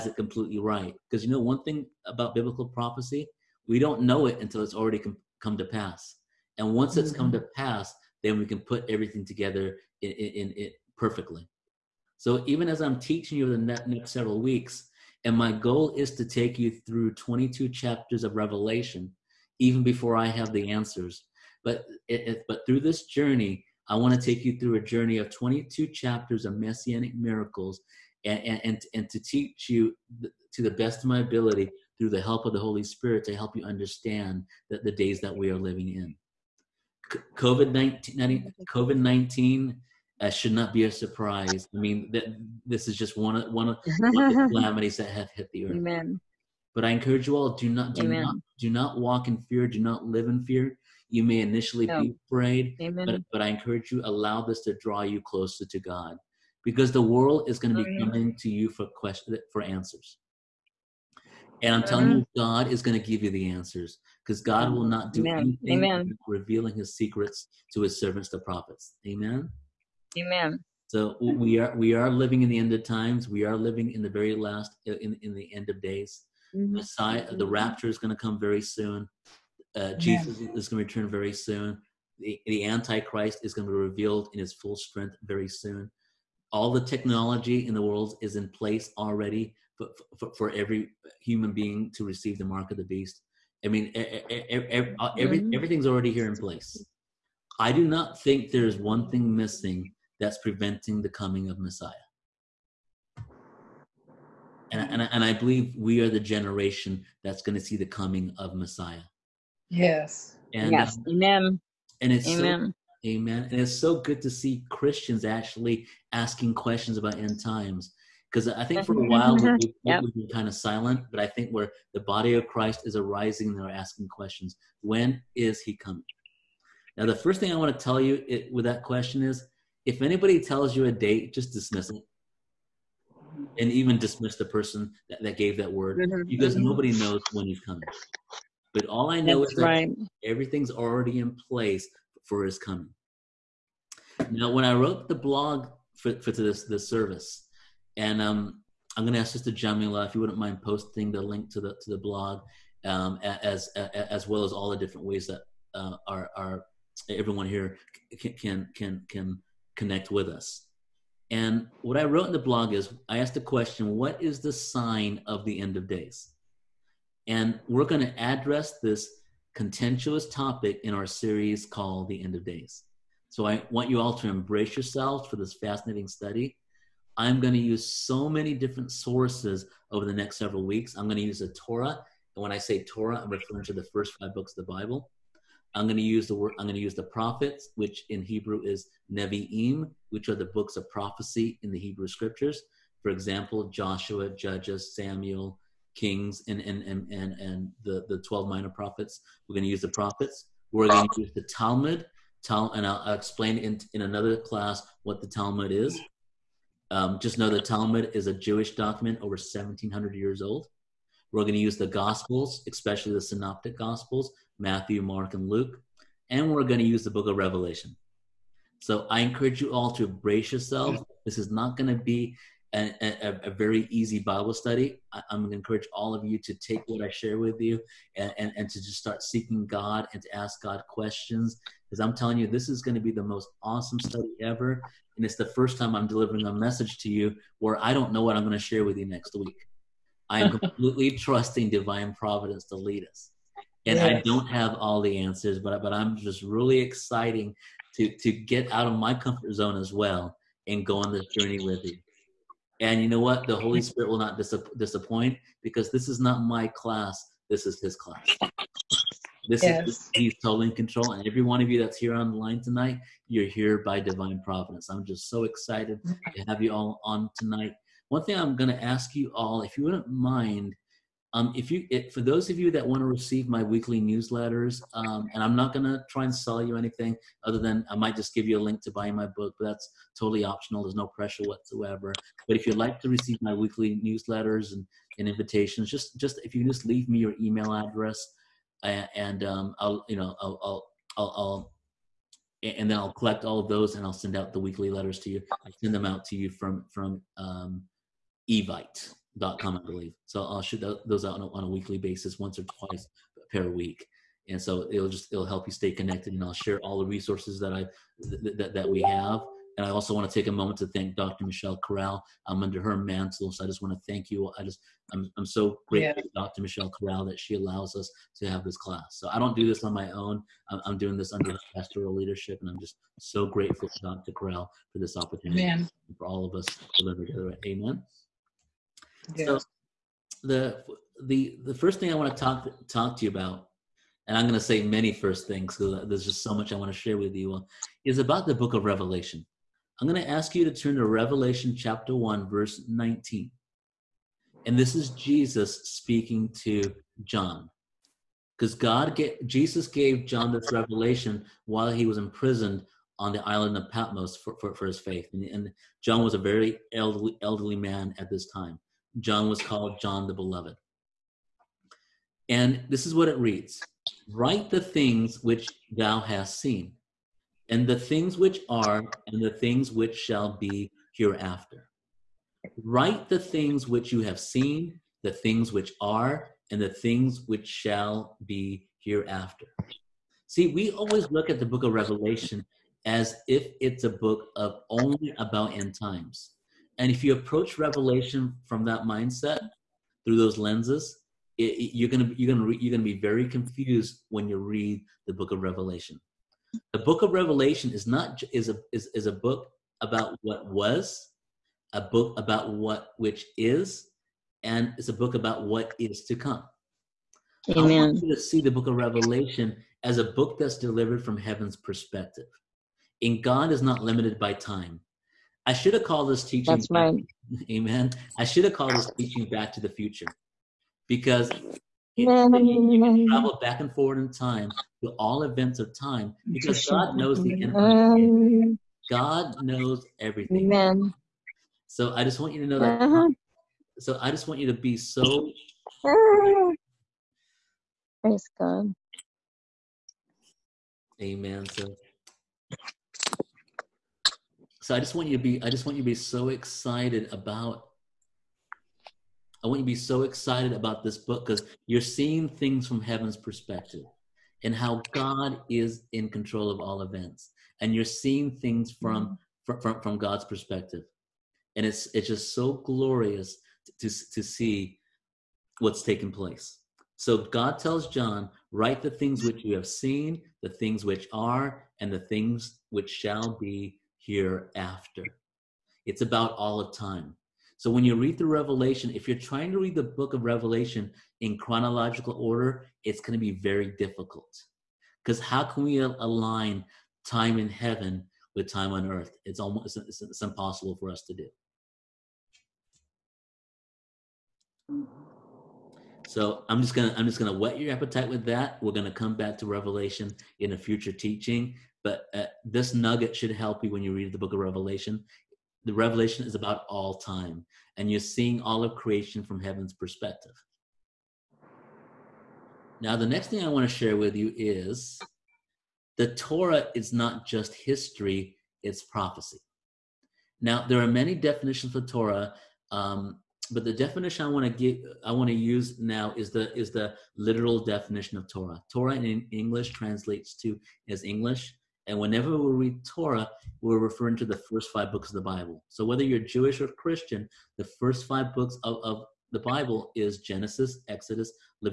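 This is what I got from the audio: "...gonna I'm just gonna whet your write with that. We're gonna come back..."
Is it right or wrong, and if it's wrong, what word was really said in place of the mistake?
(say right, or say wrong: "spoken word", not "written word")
wrong: "appetite", not "write".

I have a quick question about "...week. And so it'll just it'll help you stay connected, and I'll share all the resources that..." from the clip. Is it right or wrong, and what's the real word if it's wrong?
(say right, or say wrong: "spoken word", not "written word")
right.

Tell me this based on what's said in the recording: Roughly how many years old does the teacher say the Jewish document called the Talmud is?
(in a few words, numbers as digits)
over 1700 years.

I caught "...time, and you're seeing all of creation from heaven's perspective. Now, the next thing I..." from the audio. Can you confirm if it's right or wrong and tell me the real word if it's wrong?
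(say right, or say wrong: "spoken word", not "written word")
right.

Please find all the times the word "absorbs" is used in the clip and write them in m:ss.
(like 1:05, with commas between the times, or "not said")
not said.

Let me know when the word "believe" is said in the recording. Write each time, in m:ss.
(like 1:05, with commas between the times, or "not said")
1:45, 4:59.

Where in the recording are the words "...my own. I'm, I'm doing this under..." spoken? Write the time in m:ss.
5:19.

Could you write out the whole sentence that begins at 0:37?
COVID 19, COVID 19 uh, should not be a surprise.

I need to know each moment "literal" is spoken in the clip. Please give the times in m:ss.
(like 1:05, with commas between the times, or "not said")
8:47.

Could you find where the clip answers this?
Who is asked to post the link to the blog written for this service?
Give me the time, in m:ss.
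2:29.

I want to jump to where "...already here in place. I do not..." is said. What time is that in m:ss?
1:35.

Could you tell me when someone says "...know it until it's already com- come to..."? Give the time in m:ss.
0:04.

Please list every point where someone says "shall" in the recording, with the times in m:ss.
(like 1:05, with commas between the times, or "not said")
6:10, 6:17, 7:53.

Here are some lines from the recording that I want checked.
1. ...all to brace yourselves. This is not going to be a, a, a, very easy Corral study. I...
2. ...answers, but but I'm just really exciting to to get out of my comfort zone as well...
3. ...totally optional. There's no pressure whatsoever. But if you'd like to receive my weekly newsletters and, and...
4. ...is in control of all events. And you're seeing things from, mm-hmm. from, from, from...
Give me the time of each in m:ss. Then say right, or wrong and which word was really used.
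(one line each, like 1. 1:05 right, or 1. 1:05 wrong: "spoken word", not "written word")
1. 3:39 wrong: "Bible", not "Corral"
2. 4:05 right
3. 4:40 right
4. 7:35 right.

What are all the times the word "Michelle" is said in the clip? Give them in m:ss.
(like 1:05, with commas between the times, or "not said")
5:11, 5:16.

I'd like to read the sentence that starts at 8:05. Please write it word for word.
Because how can we align time in heaven with time on earth?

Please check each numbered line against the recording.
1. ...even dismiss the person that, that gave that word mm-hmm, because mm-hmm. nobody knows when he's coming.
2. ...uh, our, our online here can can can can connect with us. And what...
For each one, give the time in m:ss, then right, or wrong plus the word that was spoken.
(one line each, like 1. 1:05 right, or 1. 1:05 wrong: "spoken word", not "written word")
1. 2:13 right
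2. 2:35 wrong: "everyone", not "online".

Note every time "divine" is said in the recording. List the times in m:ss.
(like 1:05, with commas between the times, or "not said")
4:01, 4:24.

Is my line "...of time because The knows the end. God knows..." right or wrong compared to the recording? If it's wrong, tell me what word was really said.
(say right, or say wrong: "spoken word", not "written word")
wrong: "God", not "The".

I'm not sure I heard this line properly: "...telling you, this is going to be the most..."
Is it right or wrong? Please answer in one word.
right.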